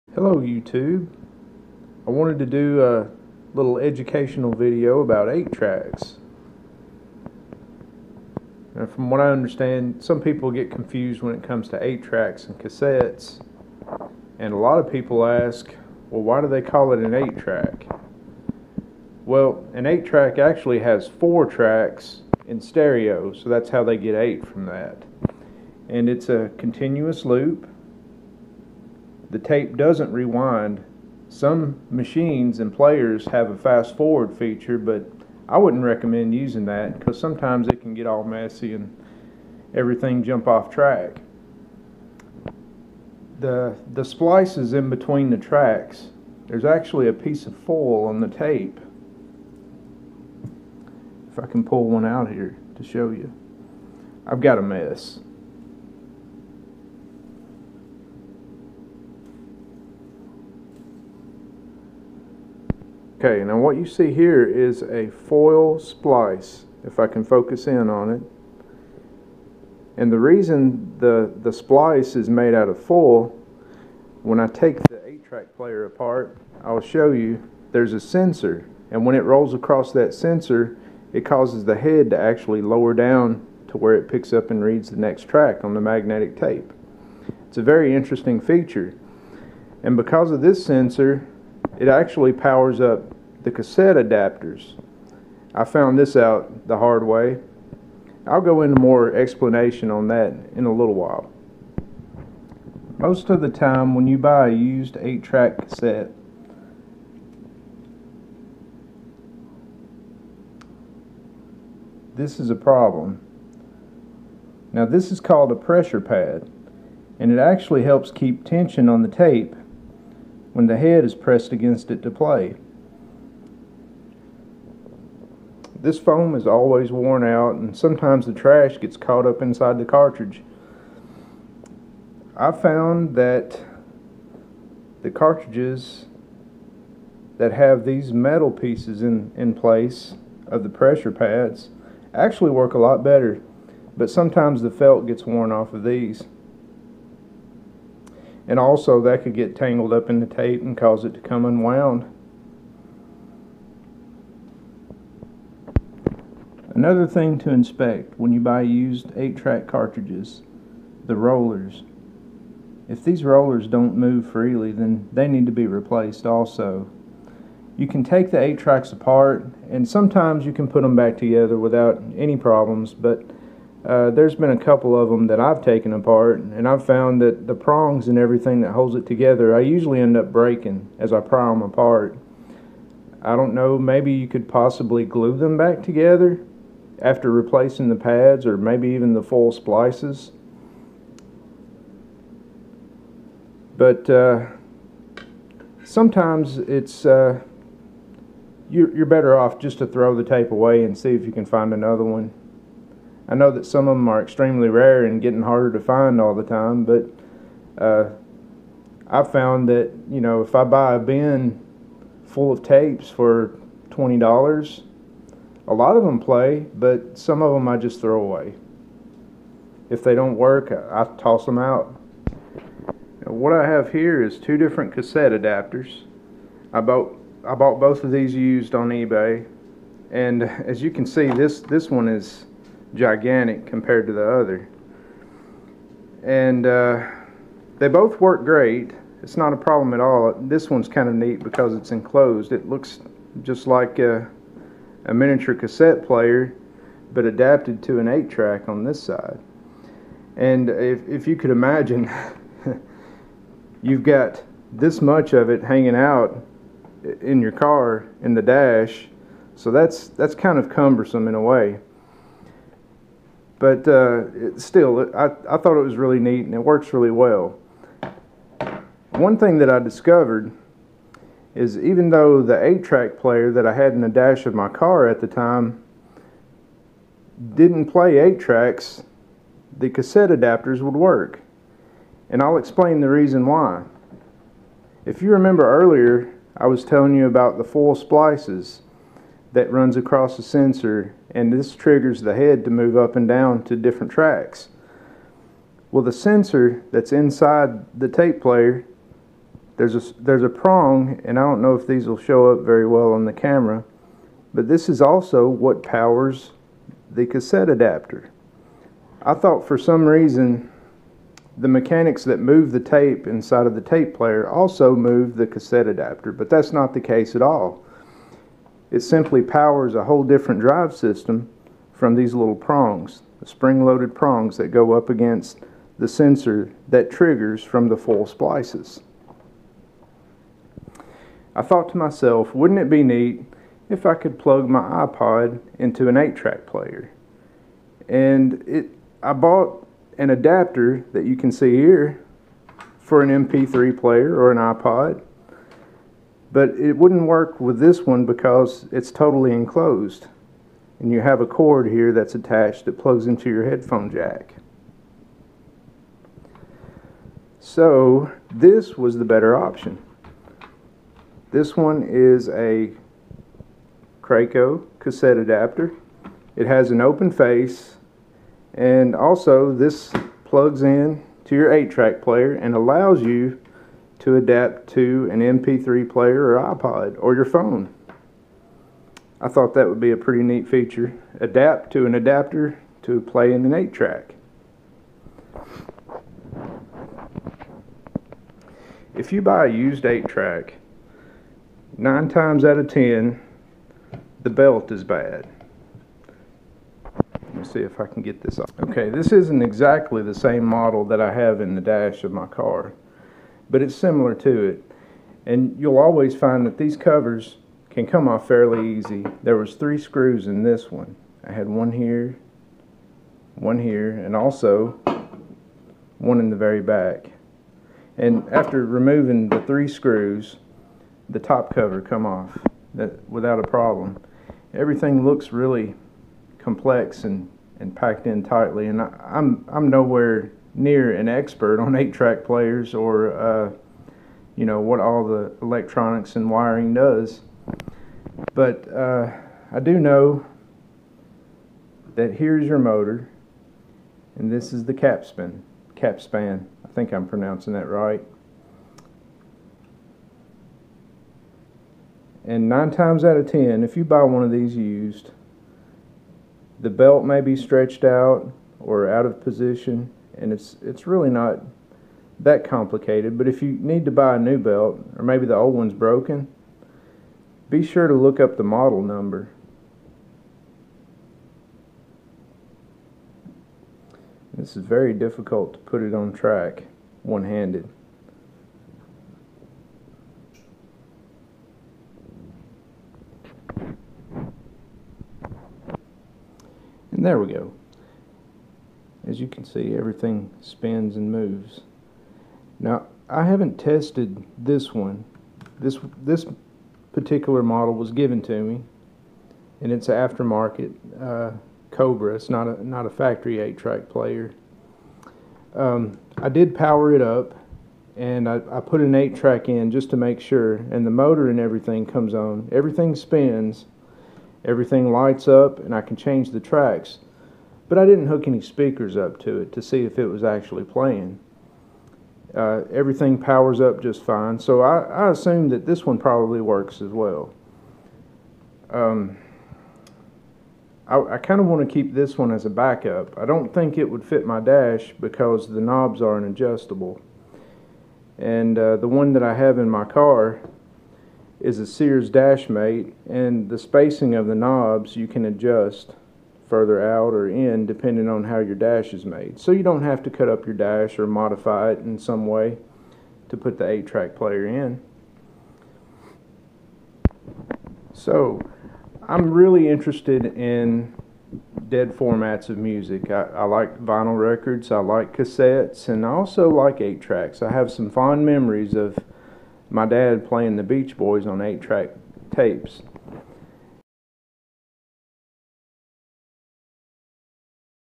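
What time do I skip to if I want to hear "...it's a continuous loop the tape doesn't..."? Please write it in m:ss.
0:26.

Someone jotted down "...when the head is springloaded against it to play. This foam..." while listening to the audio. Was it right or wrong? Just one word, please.
wrong.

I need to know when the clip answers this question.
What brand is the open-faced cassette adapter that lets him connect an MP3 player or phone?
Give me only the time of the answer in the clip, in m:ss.
6:04.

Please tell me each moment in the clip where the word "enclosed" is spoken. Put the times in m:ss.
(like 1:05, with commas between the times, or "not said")
4:01, 5:49.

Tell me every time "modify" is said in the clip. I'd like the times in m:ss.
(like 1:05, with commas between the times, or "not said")
9:11.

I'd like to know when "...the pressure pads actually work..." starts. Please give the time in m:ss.
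2:20.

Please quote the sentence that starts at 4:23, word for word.
But uh, it, still, I, I thought it was really neat and it works really well.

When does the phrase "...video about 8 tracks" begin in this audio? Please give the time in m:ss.
0:04.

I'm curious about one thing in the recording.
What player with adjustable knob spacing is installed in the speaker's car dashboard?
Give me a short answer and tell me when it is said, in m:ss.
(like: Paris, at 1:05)
Sears Dashmate, at 9:01.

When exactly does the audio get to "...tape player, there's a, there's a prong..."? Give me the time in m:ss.
4:58.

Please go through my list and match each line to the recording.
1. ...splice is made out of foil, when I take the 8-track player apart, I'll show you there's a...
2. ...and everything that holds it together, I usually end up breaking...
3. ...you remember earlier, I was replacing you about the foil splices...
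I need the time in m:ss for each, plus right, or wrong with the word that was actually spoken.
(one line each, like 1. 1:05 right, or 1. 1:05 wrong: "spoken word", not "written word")
1. 1:11 right
2. 2:58 right
3. 4:45 wrong: "telling", not "replacing".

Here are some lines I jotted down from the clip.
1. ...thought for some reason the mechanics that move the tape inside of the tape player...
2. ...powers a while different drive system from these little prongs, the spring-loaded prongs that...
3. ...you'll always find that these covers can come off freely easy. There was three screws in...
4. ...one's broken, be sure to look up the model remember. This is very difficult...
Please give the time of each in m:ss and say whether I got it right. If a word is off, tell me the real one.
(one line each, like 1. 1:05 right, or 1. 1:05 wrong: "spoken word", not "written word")
1. 5:09 right
2. 5:19 wrong: "whole", not "while"
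3. 6:45 wrong: "fairly", not "freely"
4. 7:45 wrong: "number", not "remember".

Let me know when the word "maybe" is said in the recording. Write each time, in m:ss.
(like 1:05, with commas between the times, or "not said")
3:03, 3:08, 7:45.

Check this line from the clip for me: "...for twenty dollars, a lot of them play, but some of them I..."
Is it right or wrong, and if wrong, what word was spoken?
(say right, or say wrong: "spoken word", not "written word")
right.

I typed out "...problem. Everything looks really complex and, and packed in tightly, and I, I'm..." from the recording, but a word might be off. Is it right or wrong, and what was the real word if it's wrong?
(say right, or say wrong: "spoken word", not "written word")
right.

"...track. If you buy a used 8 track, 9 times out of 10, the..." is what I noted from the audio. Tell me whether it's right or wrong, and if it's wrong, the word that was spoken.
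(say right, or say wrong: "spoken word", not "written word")
right.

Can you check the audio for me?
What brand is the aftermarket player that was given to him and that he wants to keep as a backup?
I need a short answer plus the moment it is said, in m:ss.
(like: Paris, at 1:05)
Cobra, at 8:21.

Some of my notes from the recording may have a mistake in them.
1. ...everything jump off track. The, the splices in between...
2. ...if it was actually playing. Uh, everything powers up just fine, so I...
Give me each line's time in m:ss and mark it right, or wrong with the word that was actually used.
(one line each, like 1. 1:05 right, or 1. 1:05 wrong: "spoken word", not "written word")
1. 0:39 right
2. 8:40 right.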